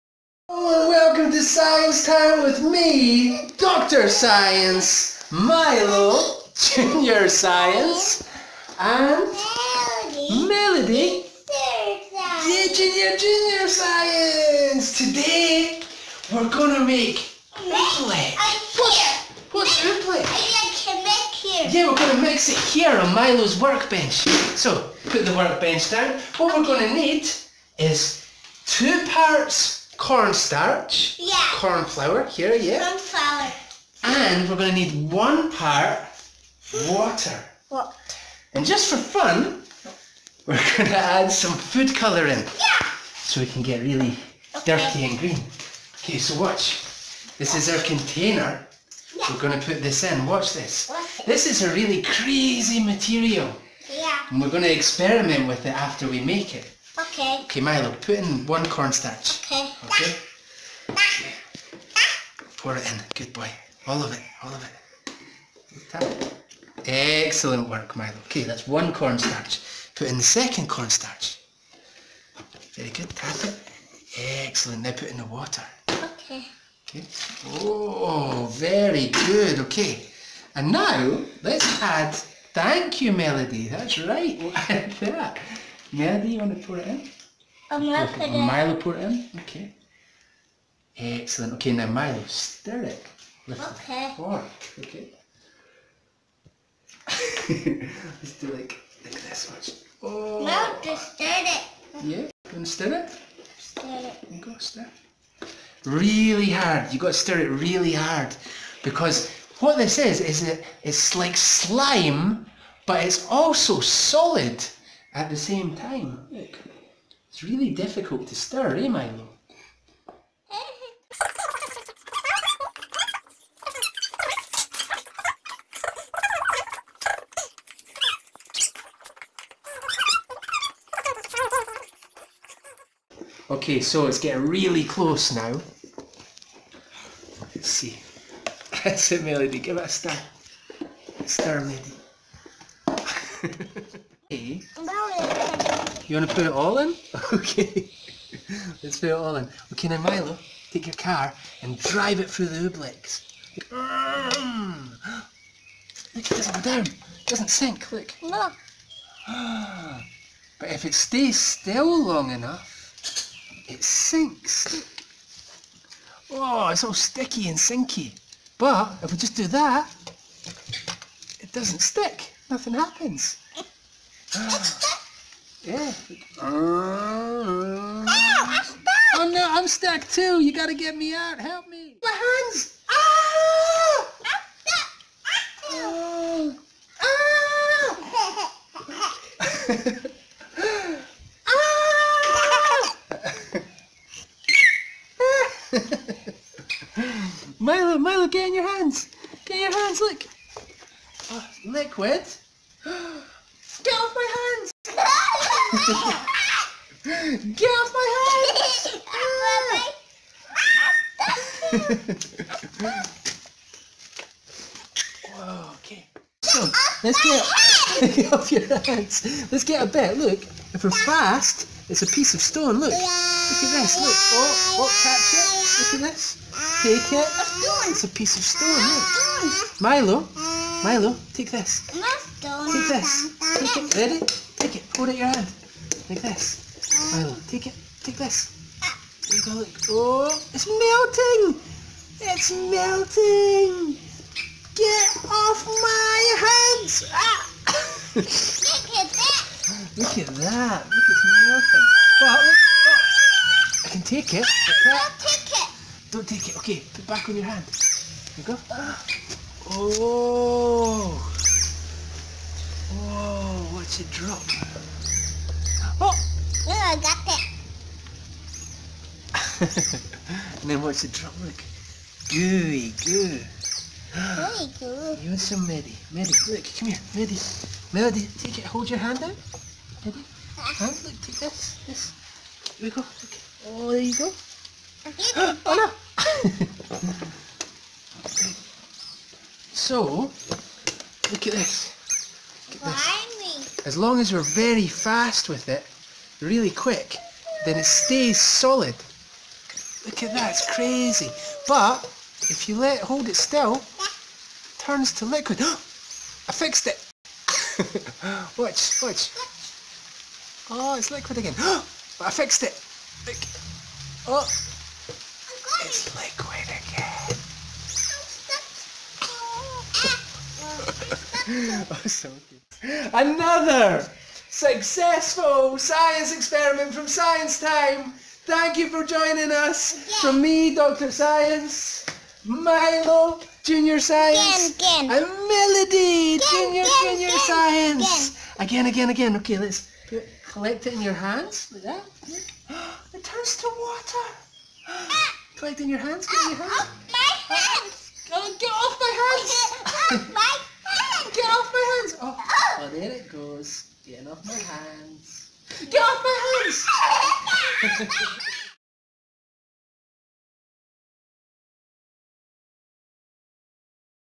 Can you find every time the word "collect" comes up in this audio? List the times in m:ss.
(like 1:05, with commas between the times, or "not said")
5:40, 5:45.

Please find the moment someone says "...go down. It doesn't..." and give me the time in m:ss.
2:36.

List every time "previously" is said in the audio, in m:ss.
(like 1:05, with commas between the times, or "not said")
not said.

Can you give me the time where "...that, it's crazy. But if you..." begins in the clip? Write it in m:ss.
5:00.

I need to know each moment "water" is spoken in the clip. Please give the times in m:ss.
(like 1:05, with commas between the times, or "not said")
0:36, 1:15, 5:43.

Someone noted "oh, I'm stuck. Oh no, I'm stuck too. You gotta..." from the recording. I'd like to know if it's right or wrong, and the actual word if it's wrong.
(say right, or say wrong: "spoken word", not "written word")
right.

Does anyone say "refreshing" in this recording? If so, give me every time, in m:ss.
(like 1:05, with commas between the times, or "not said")
not said.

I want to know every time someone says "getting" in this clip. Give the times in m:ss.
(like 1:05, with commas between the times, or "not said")
2:14, 5:54.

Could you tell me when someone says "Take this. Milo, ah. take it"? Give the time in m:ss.
3:56.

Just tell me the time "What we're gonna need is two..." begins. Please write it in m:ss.
0:26.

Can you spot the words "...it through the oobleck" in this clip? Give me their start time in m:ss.
2:32.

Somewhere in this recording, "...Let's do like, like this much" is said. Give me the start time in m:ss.
1:38.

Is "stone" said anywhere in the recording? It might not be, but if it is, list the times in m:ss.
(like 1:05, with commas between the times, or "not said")
3:42, 3:48.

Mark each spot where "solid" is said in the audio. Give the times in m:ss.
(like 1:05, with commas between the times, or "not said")
1:53, 4:58.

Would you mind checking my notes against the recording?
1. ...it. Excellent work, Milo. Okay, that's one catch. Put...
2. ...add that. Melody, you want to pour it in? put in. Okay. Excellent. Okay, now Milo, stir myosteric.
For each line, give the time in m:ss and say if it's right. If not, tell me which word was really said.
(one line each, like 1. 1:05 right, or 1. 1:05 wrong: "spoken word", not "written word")
1. 1:05 wrong: "cornstarch", not "catch"
2. 1:24 right.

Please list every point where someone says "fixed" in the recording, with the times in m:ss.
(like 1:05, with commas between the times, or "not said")
5:06, 5:12.